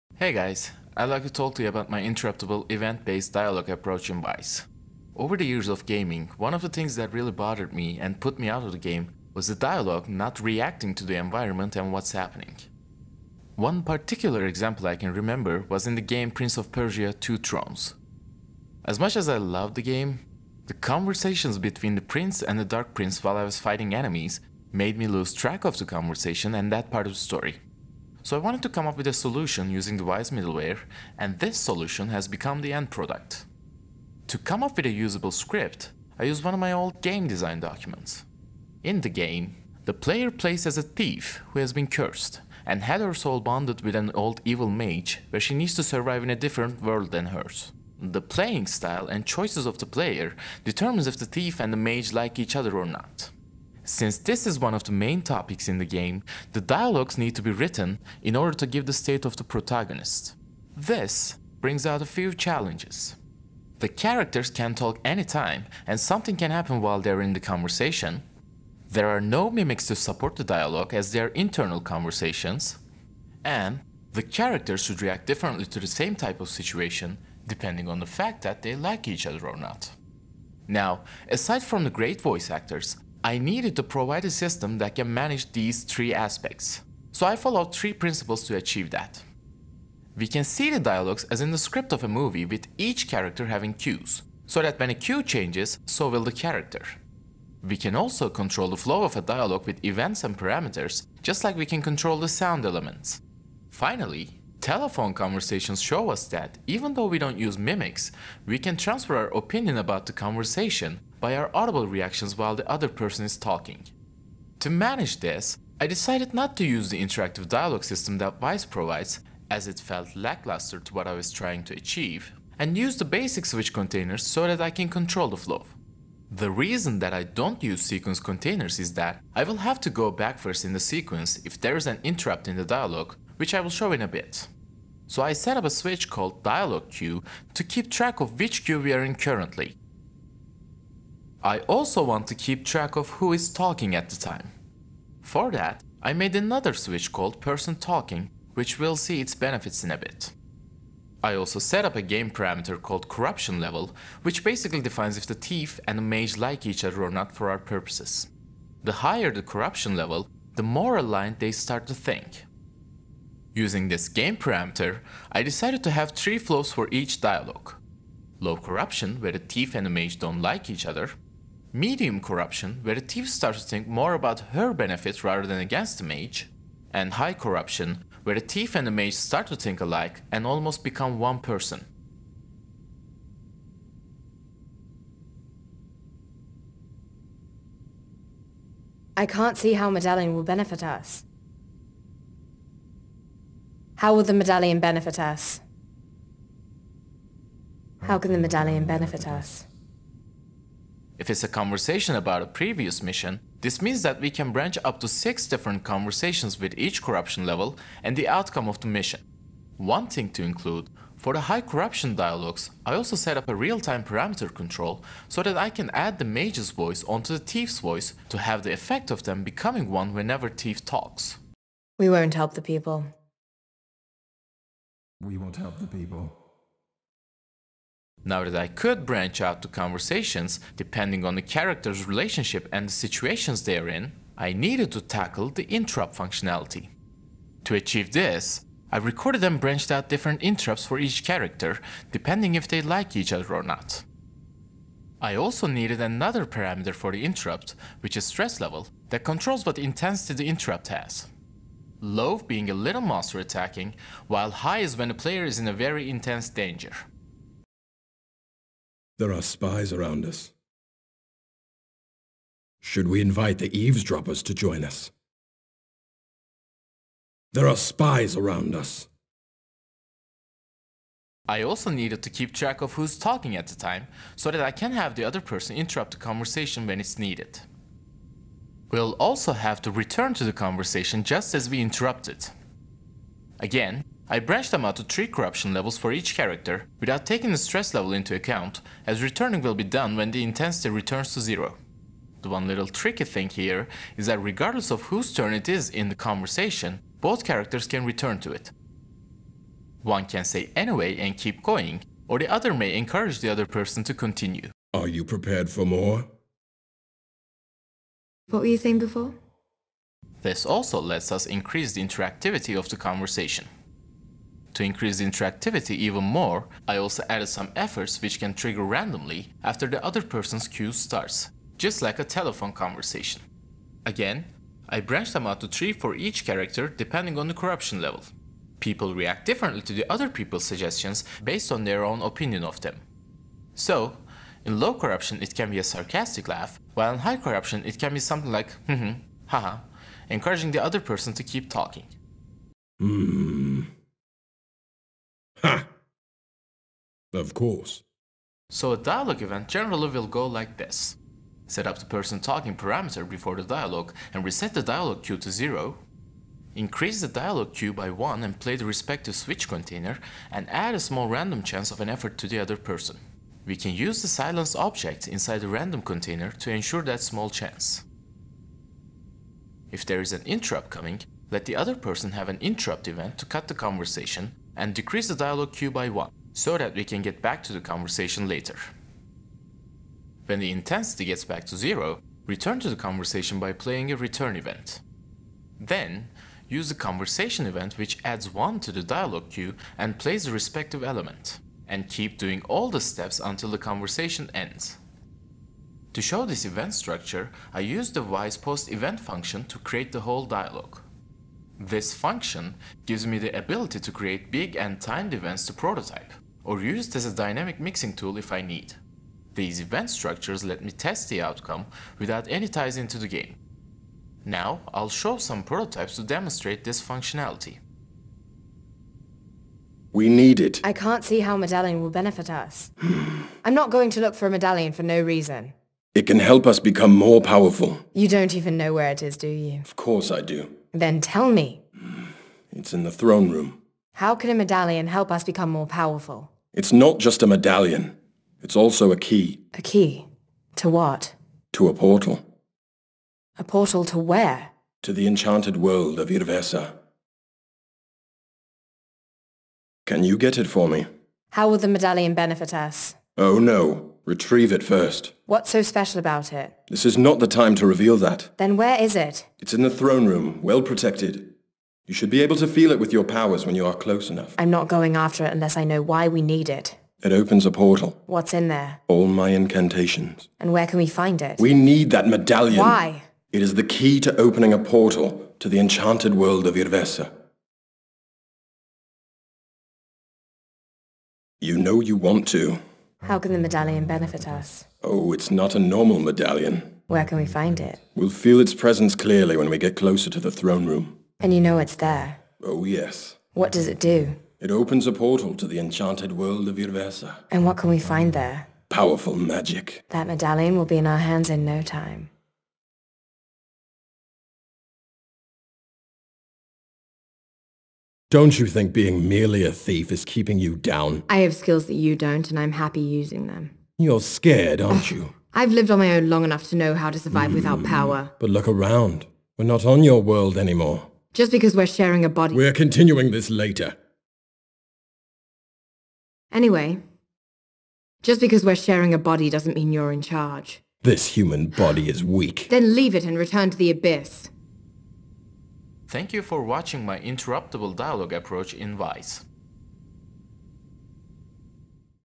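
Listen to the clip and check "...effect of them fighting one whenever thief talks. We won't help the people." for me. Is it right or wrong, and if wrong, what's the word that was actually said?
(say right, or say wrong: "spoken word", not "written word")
wrong: "becoming", not "fighting".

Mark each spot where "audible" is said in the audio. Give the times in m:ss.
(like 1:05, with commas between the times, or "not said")
1:51.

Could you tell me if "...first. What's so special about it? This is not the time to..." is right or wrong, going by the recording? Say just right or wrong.
right.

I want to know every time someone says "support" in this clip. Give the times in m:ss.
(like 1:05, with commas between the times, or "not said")
1:09.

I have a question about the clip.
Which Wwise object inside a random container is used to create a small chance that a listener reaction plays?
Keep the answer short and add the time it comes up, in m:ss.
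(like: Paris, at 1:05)
silence object, at 6:04.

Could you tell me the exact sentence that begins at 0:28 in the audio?
So I wanted to come up with a solution using the Wwise middleware, and this solution has become the end product.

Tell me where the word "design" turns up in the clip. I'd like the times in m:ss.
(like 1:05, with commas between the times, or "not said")
0:37.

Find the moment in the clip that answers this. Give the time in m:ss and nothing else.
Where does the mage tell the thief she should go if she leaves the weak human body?
8:53.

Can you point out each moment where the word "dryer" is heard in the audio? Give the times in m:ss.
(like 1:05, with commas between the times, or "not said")
not said.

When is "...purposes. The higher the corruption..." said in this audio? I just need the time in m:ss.
2:37.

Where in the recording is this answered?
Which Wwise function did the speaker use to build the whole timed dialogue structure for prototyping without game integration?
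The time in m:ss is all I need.
6:38.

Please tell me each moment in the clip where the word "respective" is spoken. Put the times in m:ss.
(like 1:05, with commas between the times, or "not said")
5:58, 6:30.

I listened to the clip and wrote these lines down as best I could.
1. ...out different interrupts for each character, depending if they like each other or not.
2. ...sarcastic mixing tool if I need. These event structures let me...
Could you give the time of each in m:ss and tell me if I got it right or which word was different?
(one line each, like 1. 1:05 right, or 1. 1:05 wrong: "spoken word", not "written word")
1. 3:59 right
2. 6:47 wrong: "dynamic", not "sarcastic".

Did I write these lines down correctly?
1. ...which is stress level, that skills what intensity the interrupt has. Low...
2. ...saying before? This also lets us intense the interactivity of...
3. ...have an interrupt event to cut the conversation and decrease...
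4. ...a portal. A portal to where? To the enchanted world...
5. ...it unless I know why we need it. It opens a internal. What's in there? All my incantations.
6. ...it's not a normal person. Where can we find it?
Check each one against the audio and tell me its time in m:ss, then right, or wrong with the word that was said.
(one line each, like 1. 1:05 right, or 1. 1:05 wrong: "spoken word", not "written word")
1. 4:08 wrong: "controls", not "skills"
2. 5:08 wrong: "increase", not "intense"
3. 6:12 right
4. 7:21 right
5. 7:45 wrong: "portal", not "internal"
6. 8:05 wrong: "medallion", not "person".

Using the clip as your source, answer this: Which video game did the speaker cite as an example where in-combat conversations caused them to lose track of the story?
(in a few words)
Prince of Persia Two Thrones.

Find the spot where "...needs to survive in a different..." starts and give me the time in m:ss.
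0:45.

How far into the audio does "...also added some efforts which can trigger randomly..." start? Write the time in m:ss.
5:16.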